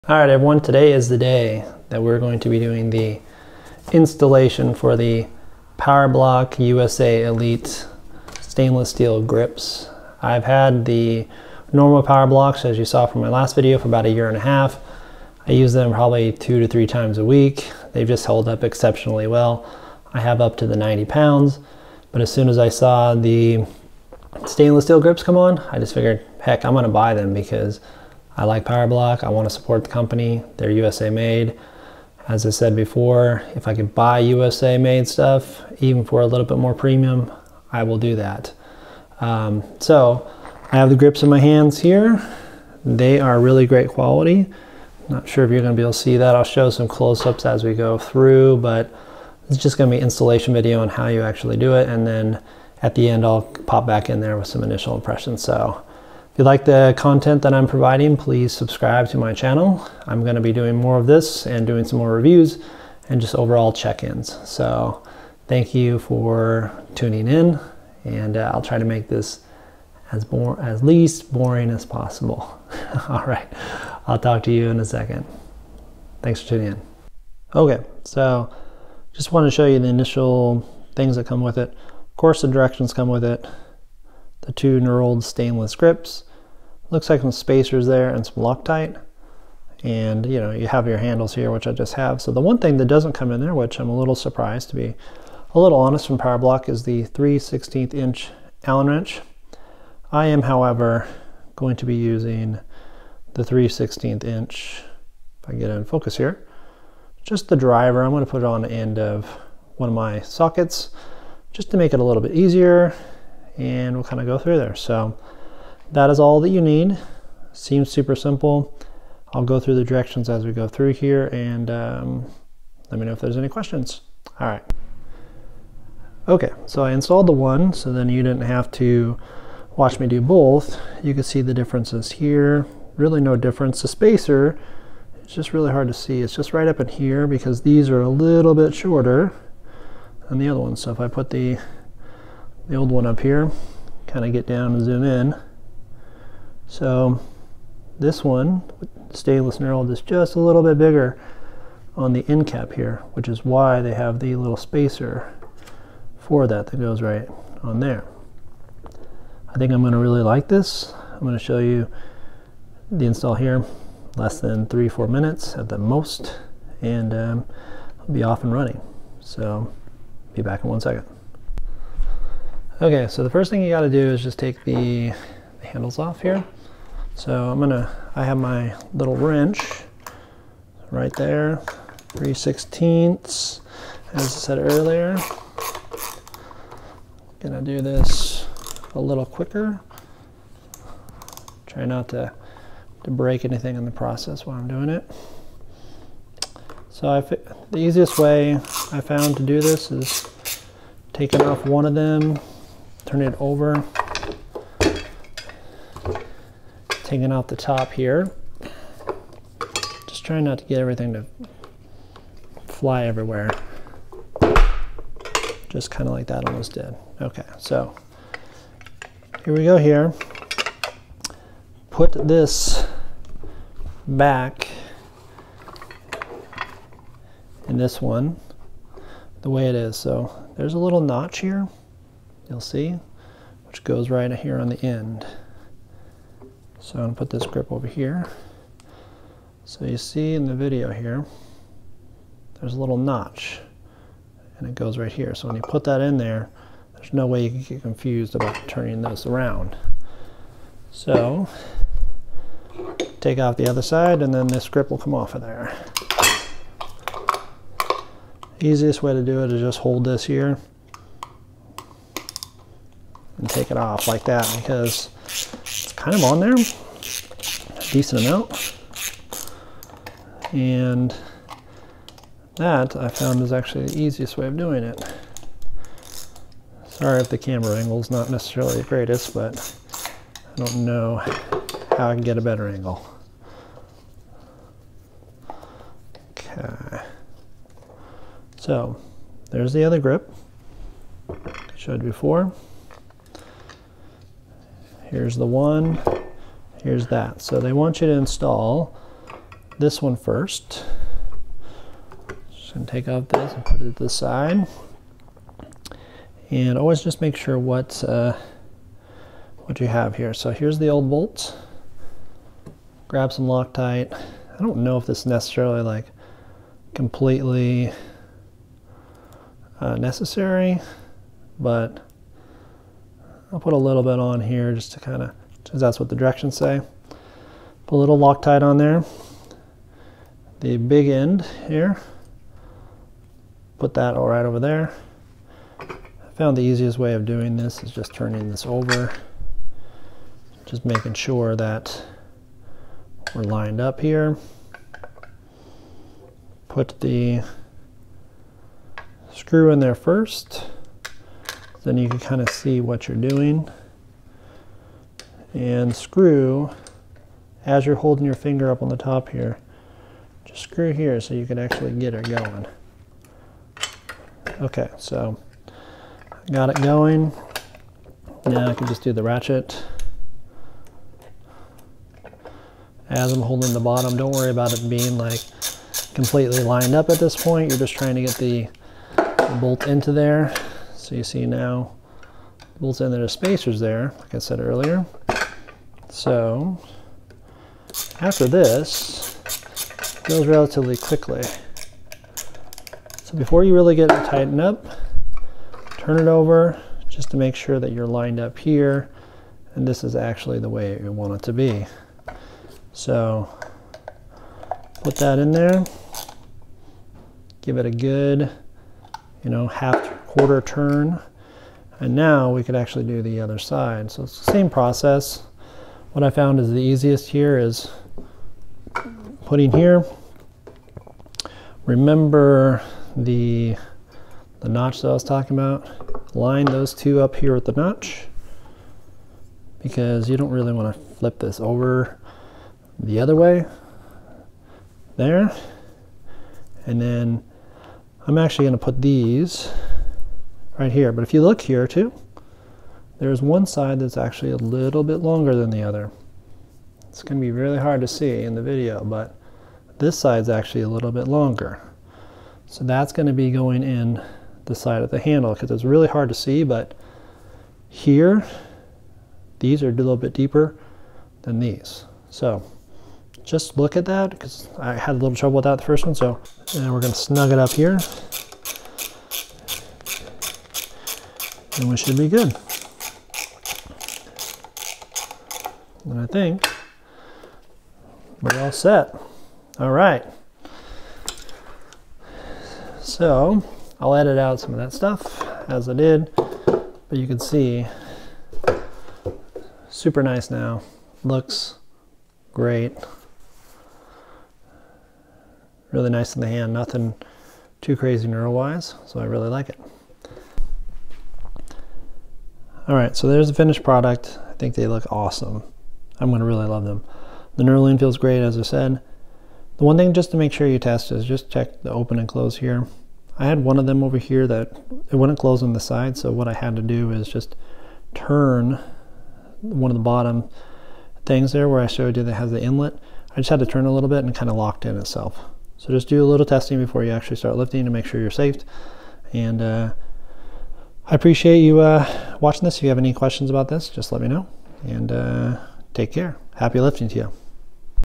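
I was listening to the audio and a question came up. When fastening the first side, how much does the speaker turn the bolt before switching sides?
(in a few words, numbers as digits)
half quarter turn.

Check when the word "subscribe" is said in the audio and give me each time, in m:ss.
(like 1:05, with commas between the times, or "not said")
0:58.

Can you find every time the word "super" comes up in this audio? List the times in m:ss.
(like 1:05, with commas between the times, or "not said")
1:57, 8:09.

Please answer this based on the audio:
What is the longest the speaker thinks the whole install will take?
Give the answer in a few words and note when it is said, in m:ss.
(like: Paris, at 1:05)
four minutes, at 2:44.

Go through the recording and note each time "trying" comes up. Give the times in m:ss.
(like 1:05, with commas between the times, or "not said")
3:30, 6:17.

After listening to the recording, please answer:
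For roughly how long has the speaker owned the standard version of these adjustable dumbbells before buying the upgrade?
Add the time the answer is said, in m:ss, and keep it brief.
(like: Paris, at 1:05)
a year and a half, at 0:13.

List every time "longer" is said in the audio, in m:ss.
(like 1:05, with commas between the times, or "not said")
7:25, 7:31.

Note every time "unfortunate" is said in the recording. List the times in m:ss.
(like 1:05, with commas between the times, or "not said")
not said.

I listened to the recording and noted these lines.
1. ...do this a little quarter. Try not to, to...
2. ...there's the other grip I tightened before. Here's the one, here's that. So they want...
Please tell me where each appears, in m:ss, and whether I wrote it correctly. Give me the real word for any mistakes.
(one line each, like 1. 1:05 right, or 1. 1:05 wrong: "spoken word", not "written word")
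1. 3:07 wrong: "quicker", not "quarter"
2. 4:49 wrong: "showed", not "tightened".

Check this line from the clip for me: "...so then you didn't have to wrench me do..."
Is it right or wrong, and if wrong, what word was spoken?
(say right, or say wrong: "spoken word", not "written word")
wrong: "watch", not "wrench".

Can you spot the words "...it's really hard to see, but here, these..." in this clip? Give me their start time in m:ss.
7:35.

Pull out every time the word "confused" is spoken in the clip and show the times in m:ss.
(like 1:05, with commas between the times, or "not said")
4:07.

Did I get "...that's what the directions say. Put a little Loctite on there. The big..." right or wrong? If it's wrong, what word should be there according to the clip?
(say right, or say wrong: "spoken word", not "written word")
right.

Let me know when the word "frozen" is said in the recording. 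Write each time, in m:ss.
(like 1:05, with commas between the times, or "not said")
not said.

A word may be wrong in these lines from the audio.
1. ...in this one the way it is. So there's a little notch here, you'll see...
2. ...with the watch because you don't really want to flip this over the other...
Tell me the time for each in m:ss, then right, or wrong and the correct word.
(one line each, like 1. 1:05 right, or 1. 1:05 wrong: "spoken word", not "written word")
1. 3:47 right
2. 7:07 wrong: "notch", not "watch".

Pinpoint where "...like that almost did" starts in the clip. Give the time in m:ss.
3:36.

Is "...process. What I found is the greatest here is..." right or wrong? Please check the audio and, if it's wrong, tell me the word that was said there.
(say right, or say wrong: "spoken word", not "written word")
wrong: "easiest", not "greatest".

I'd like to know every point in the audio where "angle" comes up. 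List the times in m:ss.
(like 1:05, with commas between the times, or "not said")
4:37, 4:42.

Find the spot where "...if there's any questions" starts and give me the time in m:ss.
2:03.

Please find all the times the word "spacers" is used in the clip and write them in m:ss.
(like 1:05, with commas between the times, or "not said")
1:27, 2:13, 2:34, 6:23.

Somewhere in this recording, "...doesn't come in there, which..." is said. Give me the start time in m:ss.
1:32.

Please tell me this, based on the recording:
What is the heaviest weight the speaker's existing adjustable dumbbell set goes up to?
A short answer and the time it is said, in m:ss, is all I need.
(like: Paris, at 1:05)
90 pounds, at 0:20.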